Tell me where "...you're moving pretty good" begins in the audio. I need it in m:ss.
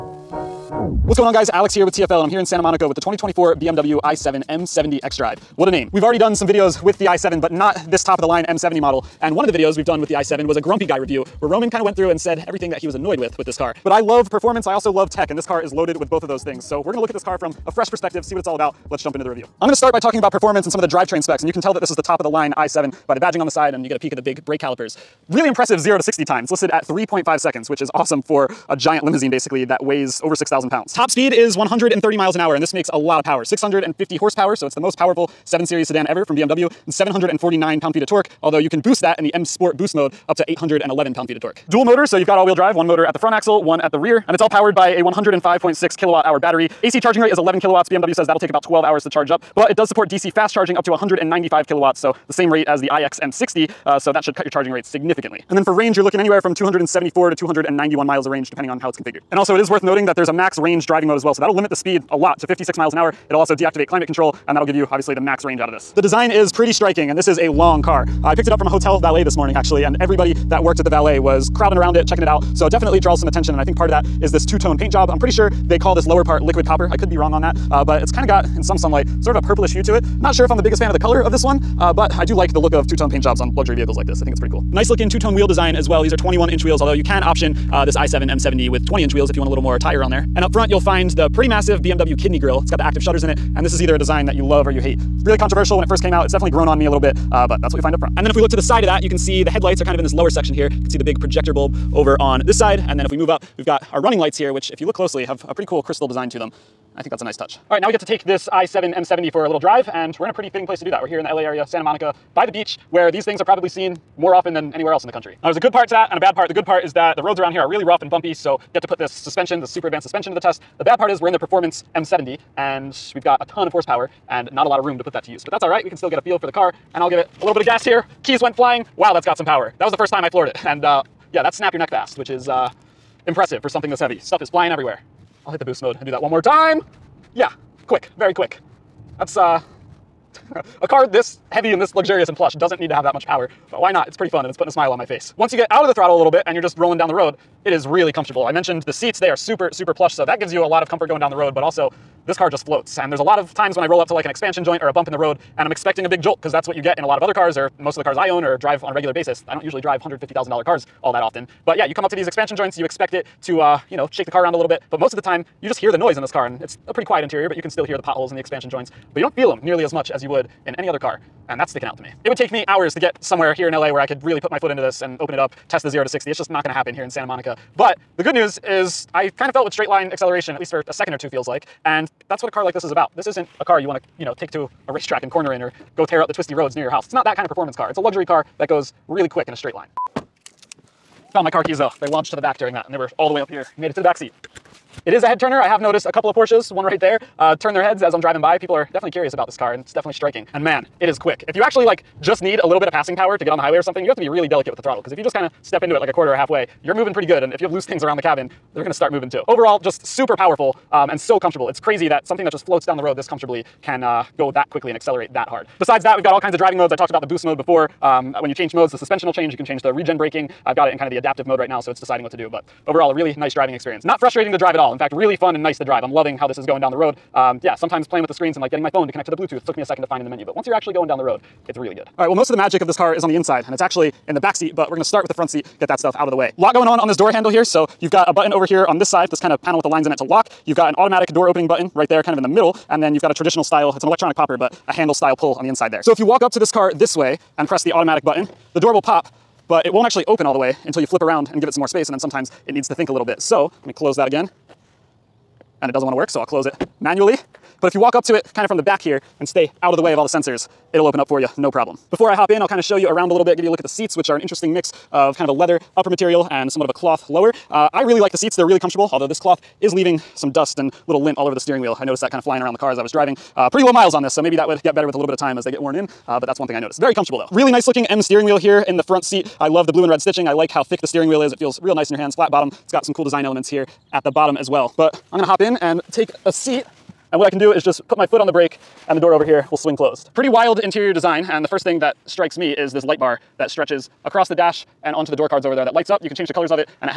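3:26.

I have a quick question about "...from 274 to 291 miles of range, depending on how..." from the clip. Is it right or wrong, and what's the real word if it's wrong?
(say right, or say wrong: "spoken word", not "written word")
right.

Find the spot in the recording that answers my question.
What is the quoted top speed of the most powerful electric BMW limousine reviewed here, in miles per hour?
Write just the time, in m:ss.
0:31.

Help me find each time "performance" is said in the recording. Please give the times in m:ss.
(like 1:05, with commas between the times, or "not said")
0:14, 0:20, 2:01, 3:07.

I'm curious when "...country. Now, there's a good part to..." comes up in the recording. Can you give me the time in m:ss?
1:55.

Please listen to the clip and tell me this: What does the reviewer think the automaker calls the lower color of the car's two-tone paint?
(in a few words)
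liquid copper.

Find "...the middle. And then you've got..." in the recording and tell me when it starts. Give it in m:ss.
4:02.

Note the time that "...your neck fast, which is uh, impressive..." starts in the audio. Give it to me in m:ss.
2:11.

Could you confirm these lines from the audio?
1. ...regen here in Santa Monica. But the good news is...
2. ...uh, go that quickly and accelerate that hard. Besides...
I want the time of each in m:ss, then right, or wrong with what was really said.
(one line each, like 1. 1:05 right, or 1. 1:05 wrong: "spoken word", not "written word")
1. 2:56 wrong: "happen", not "regen"
2. 3:34 right.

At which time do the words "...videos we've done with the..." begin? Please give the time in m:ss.
0:09.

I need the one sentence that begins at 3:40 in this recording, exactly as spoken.
I've got it in kind of the adaptive mode right now, so it's deciding what to do.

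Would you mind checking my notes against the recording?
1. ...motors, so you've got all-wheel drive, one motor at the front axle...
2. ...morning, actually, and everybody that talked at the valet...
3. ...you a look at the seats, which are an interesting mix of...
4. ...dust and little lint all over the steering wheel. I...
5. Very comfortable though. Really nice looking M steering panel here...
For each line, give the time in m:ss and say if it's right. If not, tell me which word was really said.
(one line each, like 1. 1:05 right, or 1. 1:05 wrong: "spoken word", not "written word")
1. 0:41 right
2. 1:09 wrong: "worked", not "talked"
3. 4:23 right
4. 4:30 right
5. 4:36 wrong: "wheel", not "panel".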